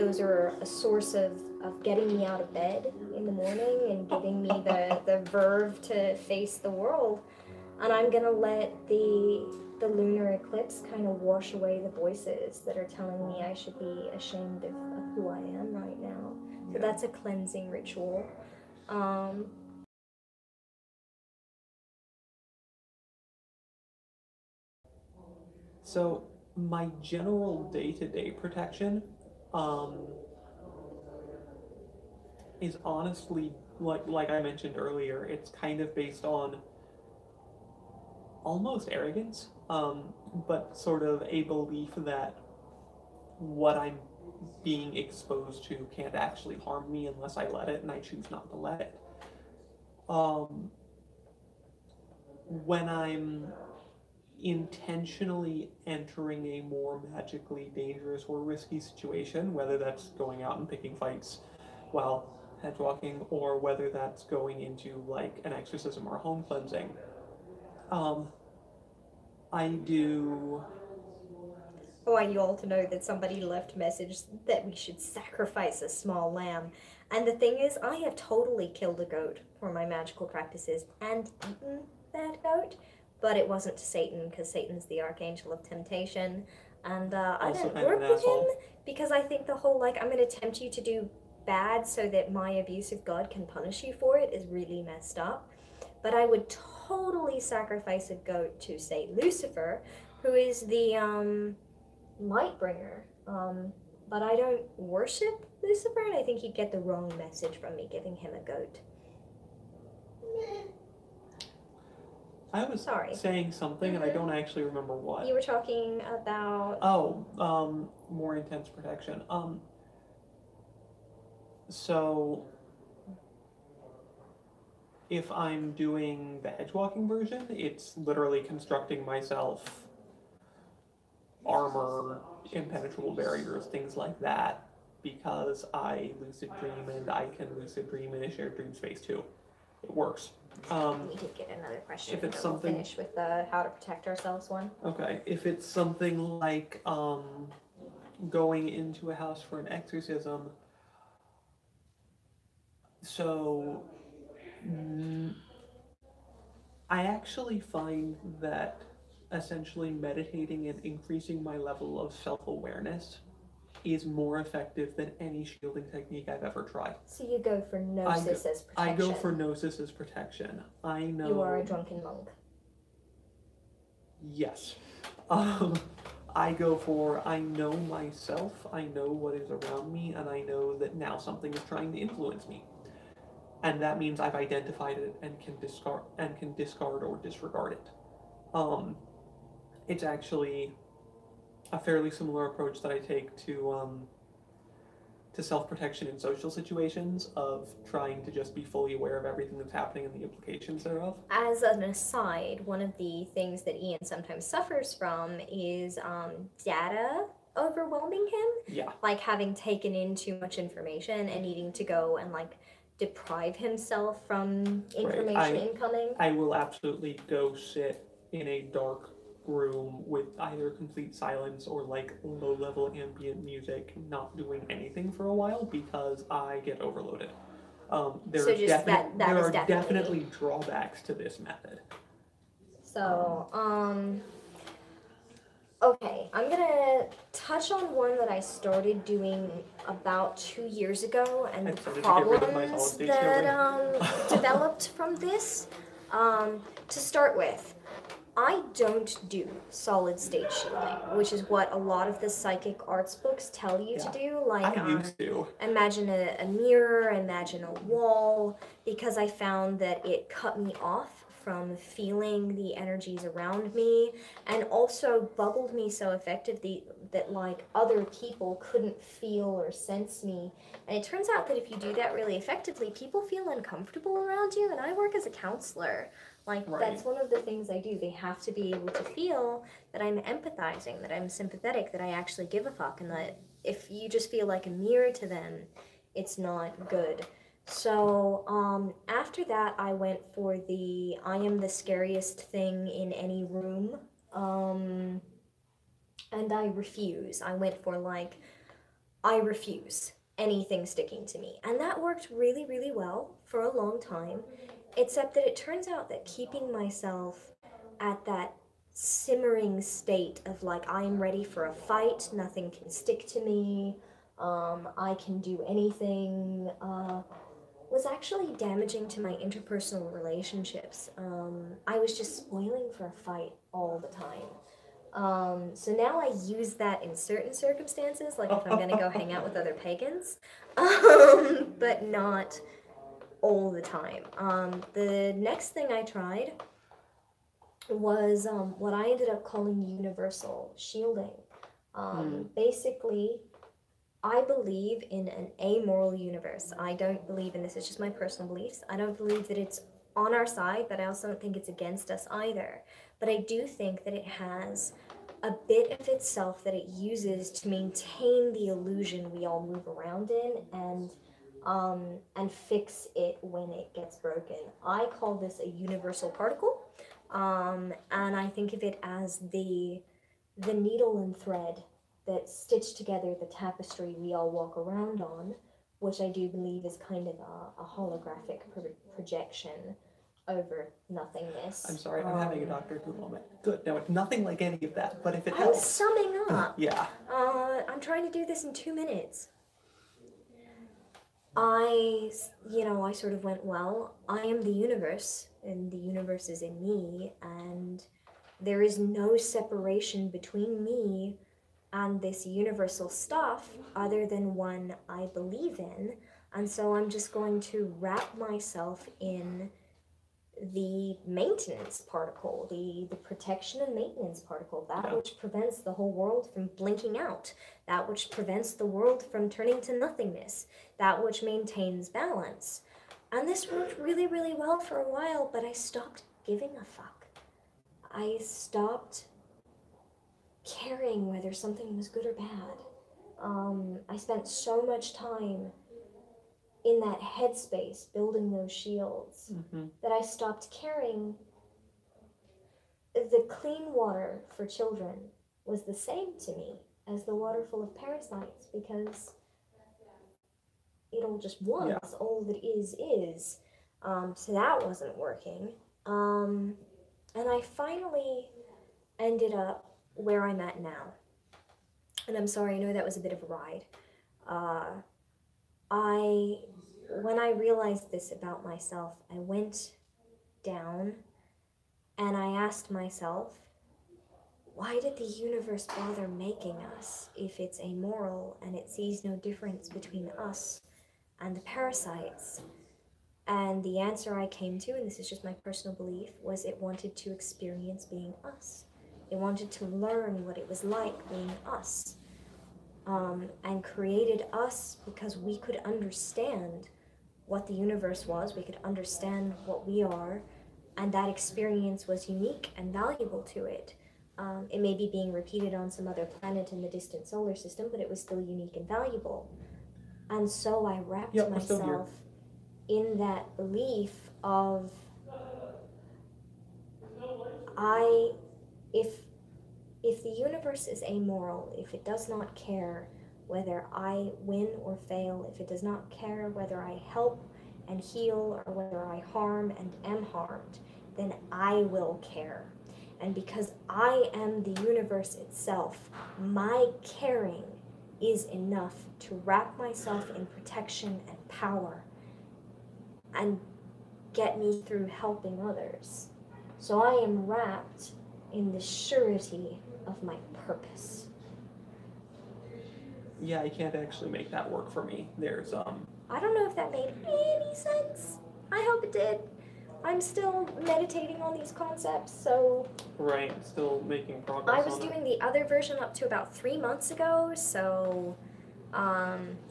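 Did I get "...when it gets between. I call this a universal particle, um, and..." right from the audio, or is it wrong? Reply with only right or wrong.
wrong.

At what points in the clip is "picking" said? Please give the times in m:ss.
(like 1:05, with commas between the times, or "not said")
1:00.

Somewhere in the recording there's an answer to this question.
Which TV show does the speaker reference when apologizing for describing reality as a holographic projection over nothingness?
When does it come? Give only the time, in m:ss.
6:22.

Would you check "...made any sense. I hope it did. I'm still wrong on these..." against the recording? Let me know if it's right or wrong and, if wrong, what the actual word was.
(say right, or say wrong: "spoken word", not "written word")
wrong: "meditating", not "wrong".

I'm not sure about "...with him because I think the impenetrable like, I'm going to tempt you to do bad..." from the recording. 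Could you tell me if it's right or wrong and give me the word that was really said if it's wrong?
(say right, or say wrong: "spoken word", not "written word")
wrong: "whole", not "impenetrable".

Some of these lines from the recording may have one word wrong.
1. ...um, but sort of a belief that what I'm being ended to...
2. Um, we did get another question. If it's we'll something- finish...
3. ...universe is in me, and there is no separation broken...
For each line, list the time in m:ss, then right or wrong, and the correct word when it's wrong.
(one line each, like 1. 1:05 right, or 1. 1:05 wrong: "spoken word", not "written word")
1. 0:39 wrong: "exposed", not "ended"
2. 2:20 right
3. 6:35 wrong: "between", not "broken".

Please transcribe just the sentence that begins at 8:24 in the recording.
Um, it may be being repeated on some other planet in the distant solar system, but it was still unique and valuable.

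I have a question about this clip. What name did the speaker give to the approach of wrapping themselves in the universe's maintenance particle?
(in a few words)
Universal shielding.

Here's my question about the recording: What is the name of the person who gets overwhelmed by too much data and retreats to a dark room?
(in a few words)
Ian.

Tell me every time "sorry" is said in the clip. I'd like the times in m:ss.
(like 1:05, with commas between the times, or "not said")
1:52, 6:21, 7:42.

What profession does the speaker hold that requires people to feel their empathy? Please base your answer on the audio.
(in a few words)
Counselor.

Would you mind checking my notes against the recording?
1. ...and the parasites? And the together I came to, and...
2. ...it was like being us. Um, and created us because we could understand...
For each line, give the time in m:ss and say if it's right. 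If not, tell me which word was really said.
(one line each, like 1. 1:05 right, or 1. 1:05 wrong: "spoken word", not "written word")
1. 8:01 wrong: "answer", not "together"
2. 8:10 right.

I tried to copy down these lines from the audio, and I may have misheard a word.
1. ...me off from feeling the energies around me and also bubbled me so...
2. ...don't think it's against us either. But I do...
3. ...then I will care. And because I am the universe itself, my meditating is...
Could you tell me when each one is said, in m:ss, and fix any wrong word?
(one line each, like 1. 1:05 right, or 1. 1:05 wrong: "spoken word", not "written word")
1. 4:20 right
2. 5:51 right
3. 8:51 wrong: "caring", not "meditating".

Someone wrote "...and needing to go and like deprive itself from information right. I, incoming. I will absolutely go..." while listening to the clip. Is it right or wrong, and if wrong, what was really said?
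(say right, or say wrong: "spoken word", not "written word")
wrong: "himself", not "itself".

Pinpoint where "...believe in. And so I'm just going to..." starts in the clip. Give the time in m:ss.
6:45.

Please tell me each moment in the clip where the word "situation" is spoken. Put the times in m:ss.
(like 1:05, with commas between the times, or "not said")
0:58, 3:16.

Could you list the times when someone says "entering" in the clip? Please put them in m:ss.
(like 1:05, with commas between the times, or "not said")
0:55.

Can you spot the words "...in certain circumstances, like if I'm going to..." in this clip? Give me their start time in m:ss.
5:27.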